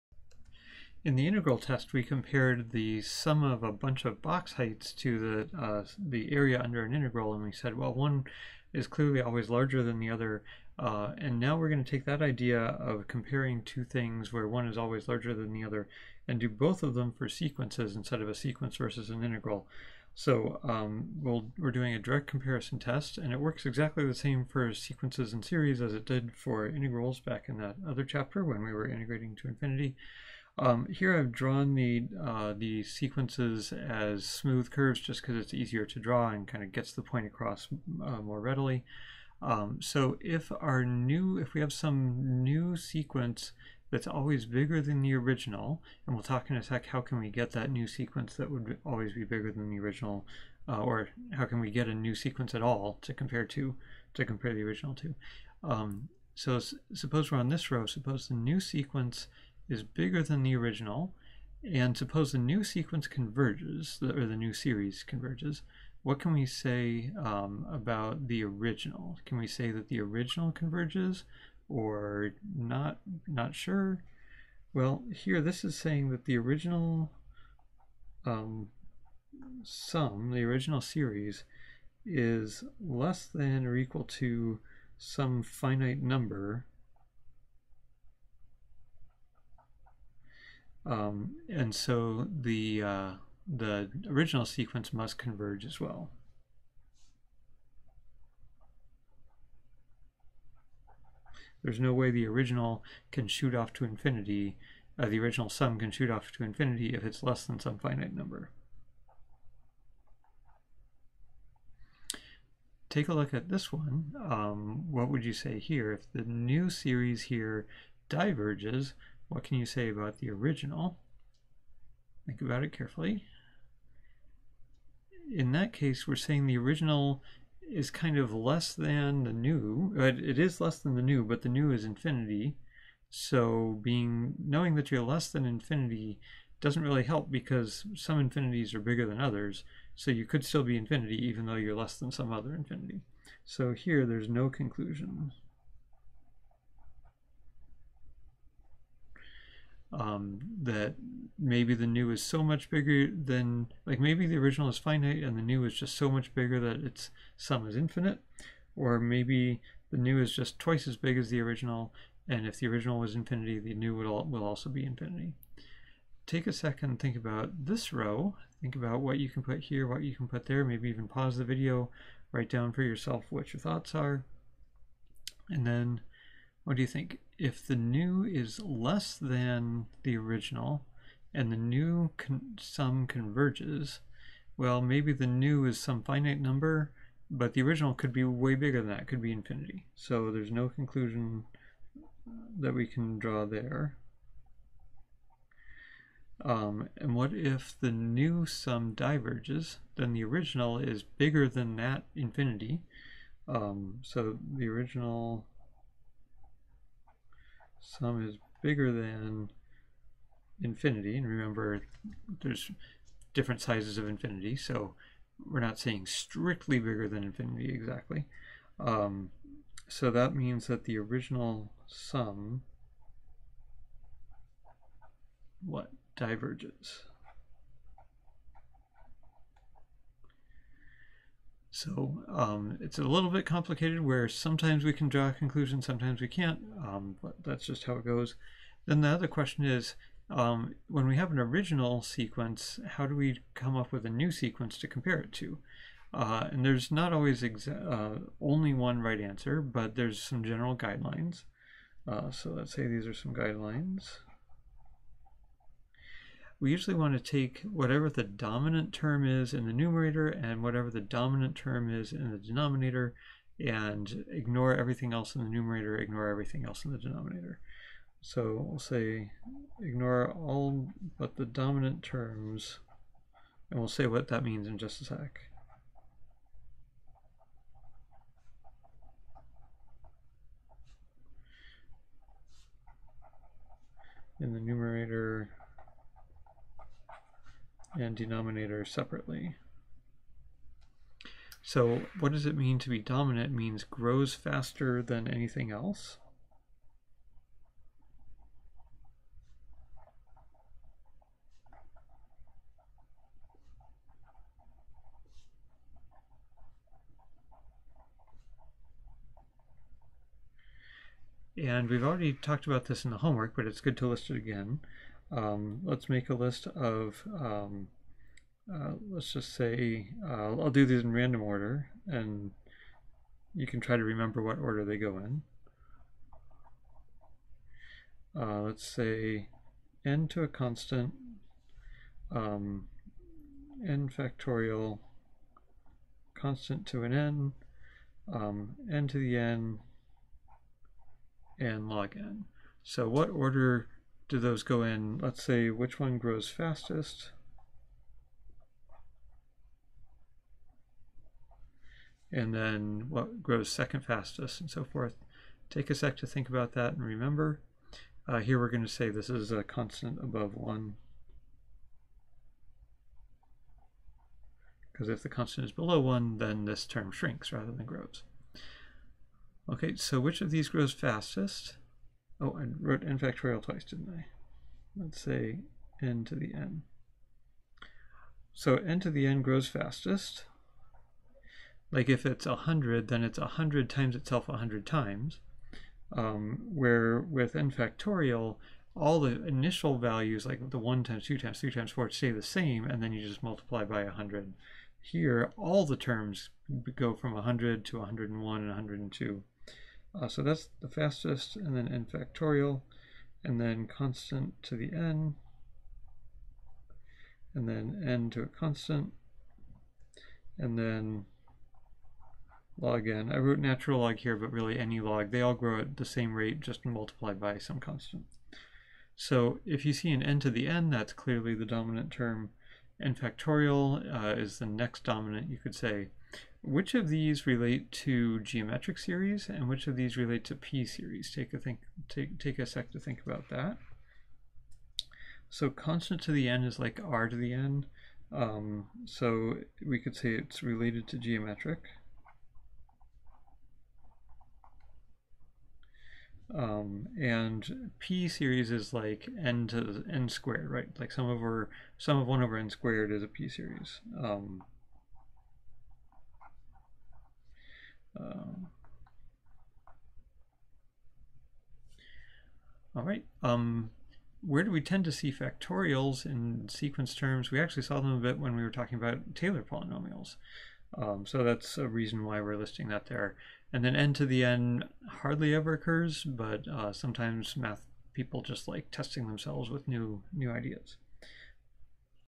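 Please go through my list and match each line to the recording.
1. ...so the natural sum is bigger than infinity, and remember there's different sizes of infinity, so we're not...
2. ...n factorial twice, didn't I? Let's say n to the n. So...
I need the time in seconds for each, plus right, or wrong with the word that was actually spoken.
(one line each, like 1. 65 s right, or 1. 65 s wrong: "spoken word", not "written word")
1. 204 s wrong: "original", not "natural"
2. 373 s right.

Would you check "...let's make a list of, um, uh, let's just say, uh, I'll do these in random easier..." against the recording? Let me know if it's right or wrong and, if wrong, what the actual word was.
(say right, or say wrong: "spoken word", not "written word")
wrong: "order", not "easier".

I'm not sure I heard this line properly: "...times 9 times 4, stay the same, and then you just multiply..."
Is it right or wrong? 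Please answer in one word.
wrong.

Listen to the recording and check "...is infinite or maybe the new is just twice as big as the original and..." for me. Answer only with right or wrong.
right.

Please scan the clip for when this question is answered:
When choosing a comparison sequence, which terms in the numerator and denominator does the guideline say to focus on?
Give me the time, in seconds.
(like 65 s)
271 s.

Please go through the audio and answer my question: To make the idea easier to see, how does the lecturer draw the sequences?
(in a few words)
smooth curves.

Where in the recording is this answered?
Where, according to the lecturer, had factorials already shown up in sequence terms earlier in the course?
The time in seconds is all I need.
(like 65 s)
469 s.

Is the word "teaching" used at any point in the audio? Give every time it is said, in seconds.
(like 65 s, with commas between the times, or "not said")
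not said.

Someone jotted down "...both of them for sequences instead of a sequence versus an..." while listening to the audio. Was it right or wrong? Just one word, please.
right.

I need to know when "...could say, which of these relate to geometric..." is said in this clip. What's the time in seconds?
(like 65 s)
425 s.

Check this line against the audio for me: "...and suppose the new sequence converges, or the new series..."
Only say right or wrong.
right.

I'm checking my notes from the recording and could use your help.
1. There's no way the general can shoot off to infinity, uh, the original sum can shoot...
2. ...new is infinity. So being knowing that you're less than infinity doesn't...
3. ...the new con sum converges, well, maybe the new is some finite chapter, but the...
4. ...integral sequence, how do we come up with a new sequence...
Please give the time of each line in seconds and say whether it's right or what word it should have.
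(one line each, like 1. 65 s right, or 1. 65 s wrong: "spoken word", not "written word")
1. 101 s wrong: "original", not "general"
2. 131 s right
3. 181 s wrong: "number", not "chapter"
4. 241 s wrong: "original", not "integral".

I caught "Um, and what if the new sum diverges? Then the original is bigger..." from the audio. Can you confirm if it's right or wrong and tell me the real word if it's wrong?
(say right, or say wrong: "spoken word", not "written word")
right.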